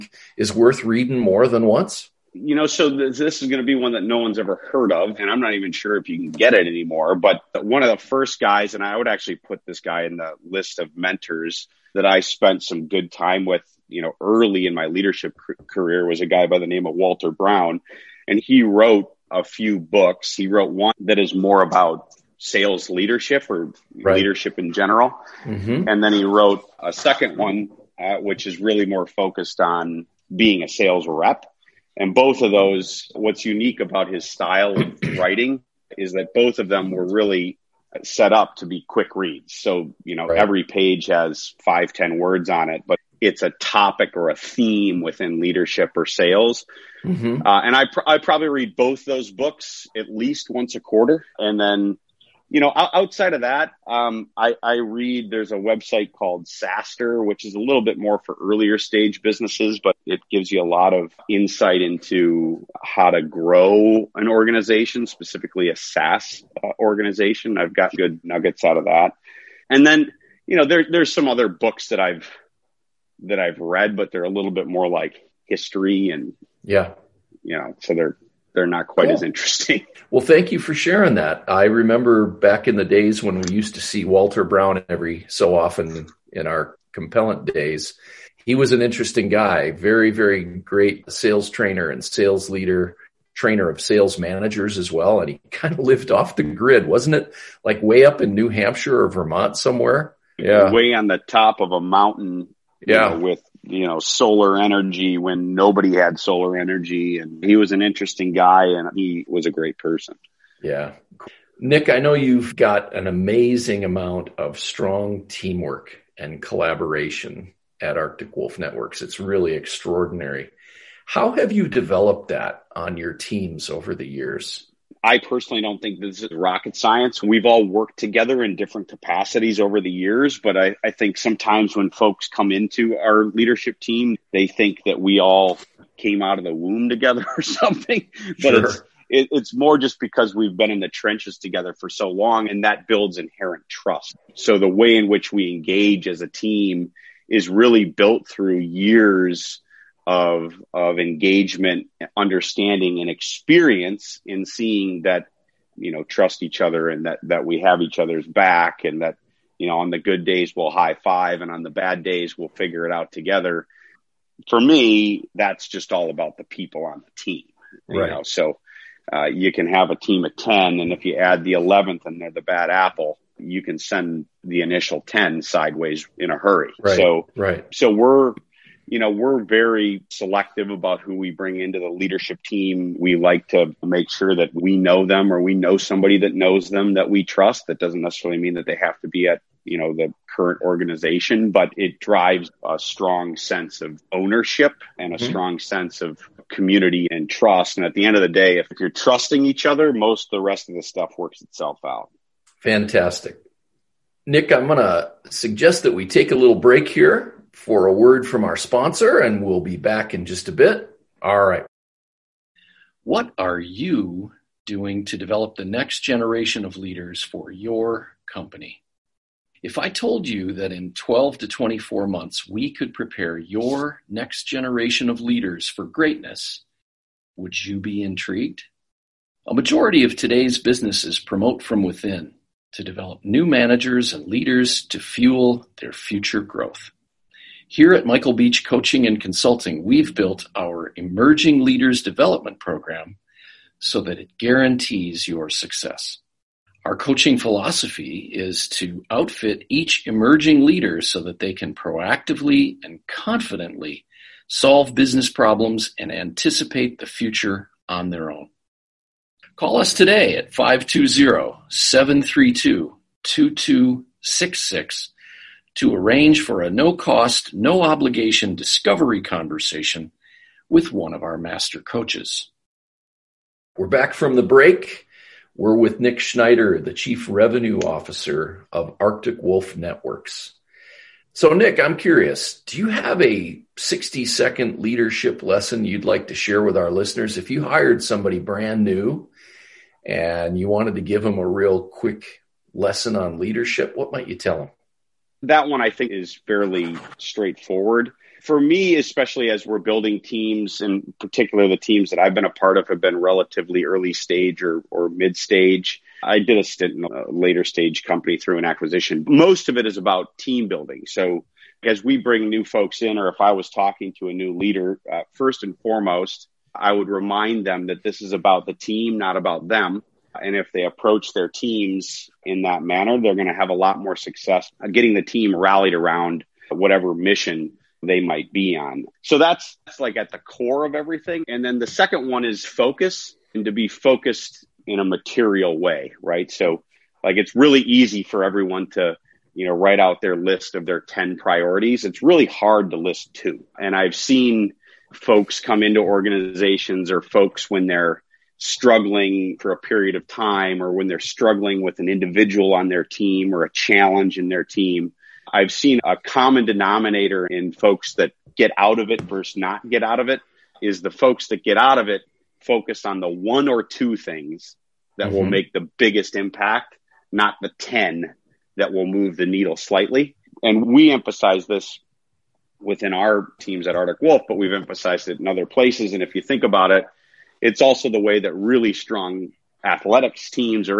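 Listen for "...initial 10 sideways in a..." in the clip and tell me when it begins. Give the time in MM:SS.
02:54.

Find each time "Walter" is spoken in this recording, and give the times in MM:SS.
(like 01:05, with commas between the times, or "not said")
00:16, 01:24.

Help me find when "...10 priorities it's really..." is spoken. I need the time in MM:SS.
05:40.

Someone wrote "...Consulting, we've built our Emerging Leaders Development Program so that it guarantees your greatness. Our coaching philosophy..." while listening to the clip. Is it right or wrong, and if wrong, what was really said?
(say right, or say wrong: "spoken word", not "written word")
wrong: "success", not "greatness".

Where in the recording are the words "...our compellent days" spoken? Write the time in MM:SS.
01:26.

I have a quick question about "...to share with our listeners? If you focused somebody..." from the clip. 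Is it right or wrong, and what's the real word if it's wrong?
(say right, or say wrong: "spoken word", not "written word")
wrong: "hired", not "focused".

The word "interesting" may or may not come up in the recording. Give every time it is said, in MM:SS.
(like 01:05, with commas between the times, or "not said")
01:19, 01:28, 01:47.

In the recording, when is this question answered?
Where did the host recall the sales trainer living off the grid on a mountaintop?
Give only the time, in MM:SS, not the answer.
01:38.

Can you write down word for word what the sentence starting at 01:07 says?
I've got good nuggets out of that.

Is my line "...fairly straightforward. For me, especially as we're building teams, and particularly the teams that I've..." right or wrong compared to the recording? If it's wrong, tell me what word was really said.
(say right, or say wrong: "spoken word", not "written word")
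right.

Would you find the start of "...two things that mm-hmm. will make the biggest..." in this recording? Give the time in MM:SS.
06:03.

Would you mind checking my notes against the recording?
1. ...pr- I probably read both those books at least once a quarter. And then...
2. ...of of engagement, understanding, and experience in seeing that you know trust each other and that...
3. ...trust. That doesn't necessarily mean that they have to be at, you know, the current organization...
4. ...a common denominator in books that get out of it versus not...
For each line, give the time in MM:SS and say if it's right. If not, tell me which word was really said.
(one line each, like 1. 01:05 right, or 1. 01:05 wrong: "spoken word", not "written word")
1. 00:47 right
2. 02:30 right
3. 03:07 right
4. 05:56 wrong: "folks", not "books".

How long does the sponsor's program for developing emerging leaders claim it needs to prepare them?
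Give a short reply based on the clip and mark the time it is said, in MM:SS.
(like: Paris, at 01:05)
12 to 24 months, at 03:40.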